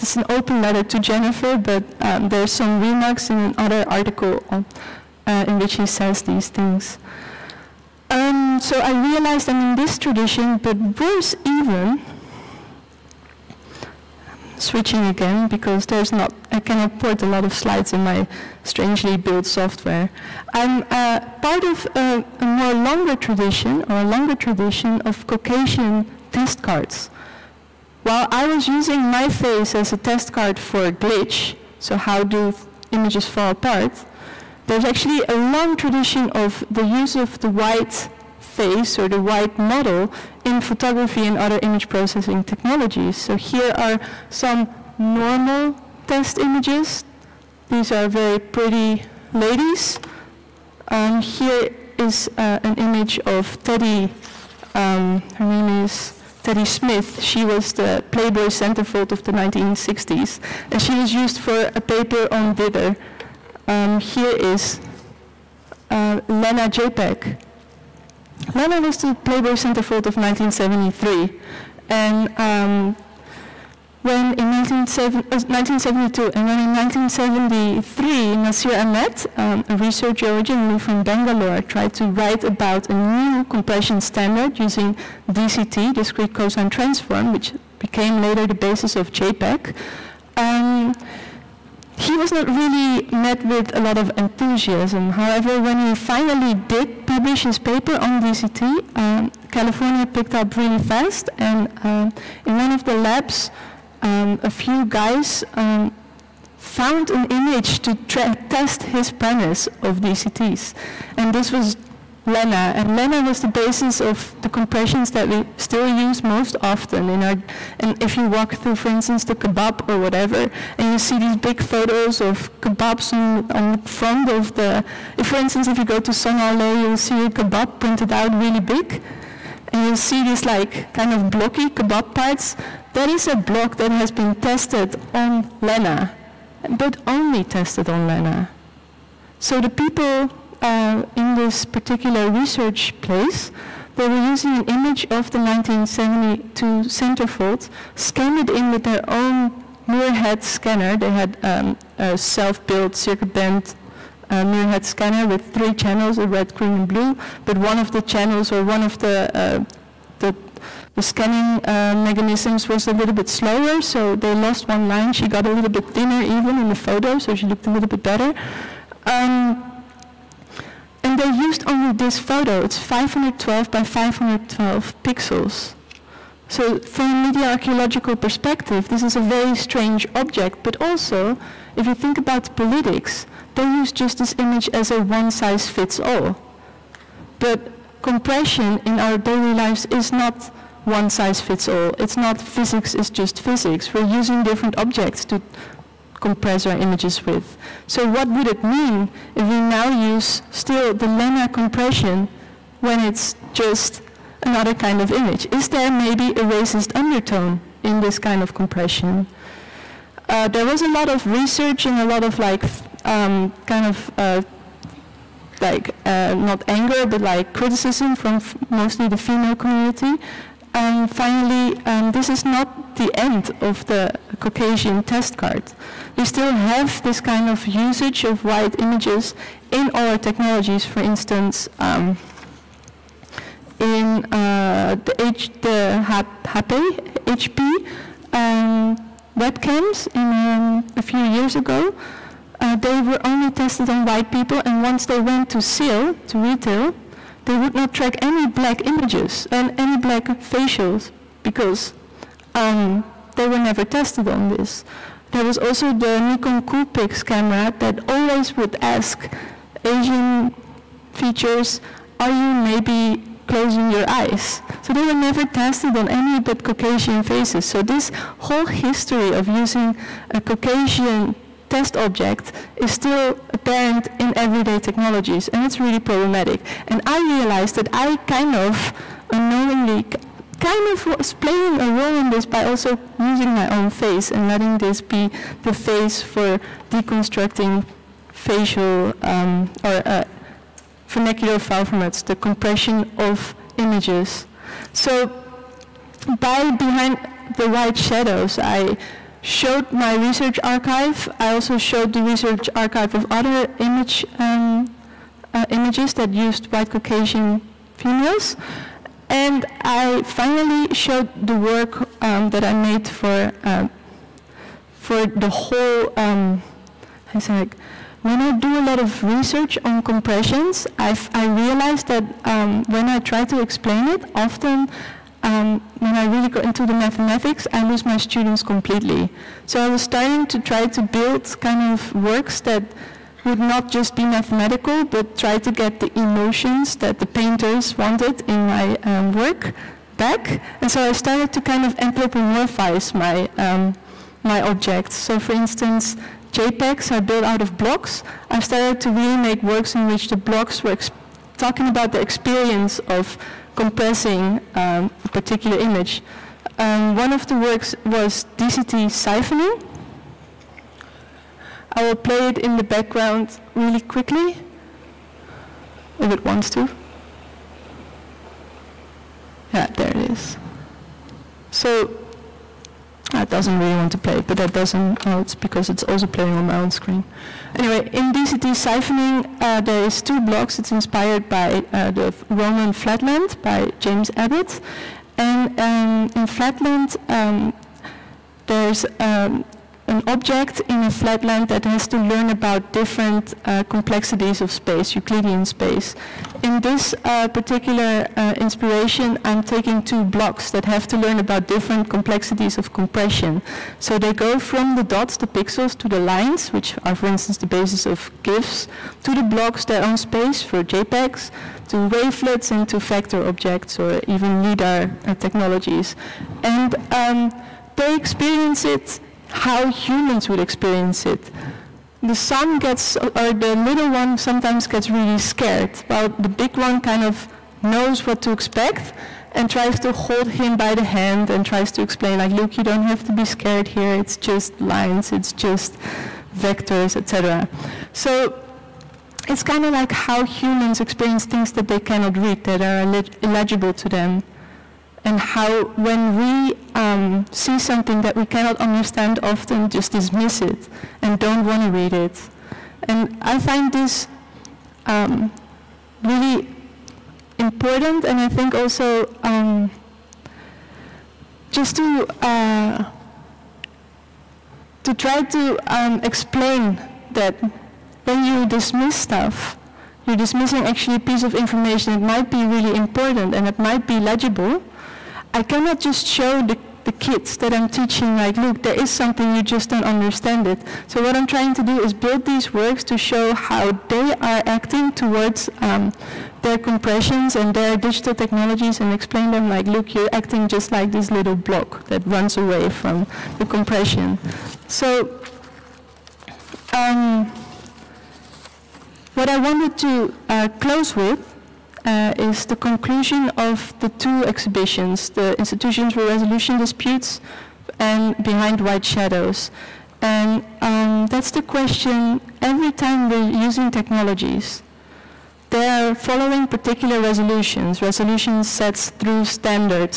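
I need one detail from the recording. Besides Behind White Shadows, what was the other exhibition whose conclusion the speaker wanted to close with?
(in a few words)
Institutions for Resolution Disputes.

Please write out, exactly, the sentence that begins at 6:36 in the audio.
In this uh, particular uh, inspiration, I'm taking two blocks that have to learn about different complexities of compression.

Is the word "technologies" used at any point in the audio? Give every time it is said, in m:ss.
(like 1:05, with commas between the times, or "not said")
0:42, 3:50, 4:34, 6:55, 8:08, 8:33.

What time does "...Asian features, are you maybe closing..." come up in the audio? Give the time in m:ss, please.
4:19.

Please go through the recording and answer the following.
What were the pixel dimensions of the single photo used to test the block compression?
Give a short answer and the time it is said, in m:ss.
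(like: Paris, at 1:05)
512 by 512, at 2:52.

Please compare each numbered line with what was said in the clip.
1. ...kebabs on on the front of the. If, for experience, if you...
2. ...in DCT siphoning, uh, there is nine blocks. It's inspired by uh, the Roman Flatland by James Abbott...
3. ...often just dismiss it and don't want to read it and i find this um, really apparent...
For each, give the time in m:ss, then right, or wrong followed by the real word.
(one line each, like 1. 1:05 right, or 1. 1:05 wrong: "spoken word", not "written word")
1. 2:02 wrong: "instance", not "experience"
2. 6:18 wrong: "two", not "nine"
3. 7:29 wrong: "important", not "apparent".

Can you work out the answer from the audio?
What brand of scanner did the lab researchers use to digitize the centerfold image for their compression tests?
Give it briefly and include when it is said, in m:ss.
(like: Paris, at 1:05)
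Muirhead, at 2:29.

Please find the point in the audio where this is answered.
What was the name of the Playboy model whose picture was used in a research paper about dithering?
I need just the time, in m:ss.
0:56.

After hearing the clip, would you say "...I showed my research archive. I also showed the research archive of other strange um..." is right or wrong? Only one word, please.
wrong.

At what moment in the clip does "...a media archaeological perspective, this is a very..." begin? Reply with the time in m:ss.
2:57.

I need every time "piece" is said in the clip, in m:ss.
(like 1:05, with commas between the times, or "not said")
7:51.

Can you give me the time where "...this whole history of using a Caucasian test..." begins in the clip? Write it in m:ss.
4:27.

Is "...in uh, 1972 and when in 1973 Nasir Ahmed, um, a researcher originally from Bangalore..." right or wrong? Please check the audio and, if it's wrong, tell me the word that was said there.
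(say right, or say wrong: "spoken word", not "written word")
right.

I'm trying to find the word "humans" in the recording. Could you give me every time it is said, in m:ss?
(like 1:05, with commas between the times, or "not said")
6:59, 7:20.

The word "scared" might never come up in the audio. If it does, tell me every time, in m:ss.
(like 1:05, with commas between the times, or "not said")
7:05, 7:13.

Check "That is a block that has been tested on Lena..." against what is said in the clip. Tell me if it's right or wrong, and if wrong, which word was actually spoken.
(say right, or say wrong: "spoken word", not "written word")
right.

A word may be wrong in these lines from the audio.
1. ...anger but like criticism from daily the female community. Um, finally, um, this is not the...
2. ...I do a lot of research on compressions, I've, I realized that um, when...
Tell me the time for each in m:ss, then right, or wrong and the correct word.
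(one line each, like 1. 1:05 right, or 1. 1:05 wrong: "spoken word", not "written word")
1. 3:36 wrong: "mostly", not "daily"
2. 5:18 right.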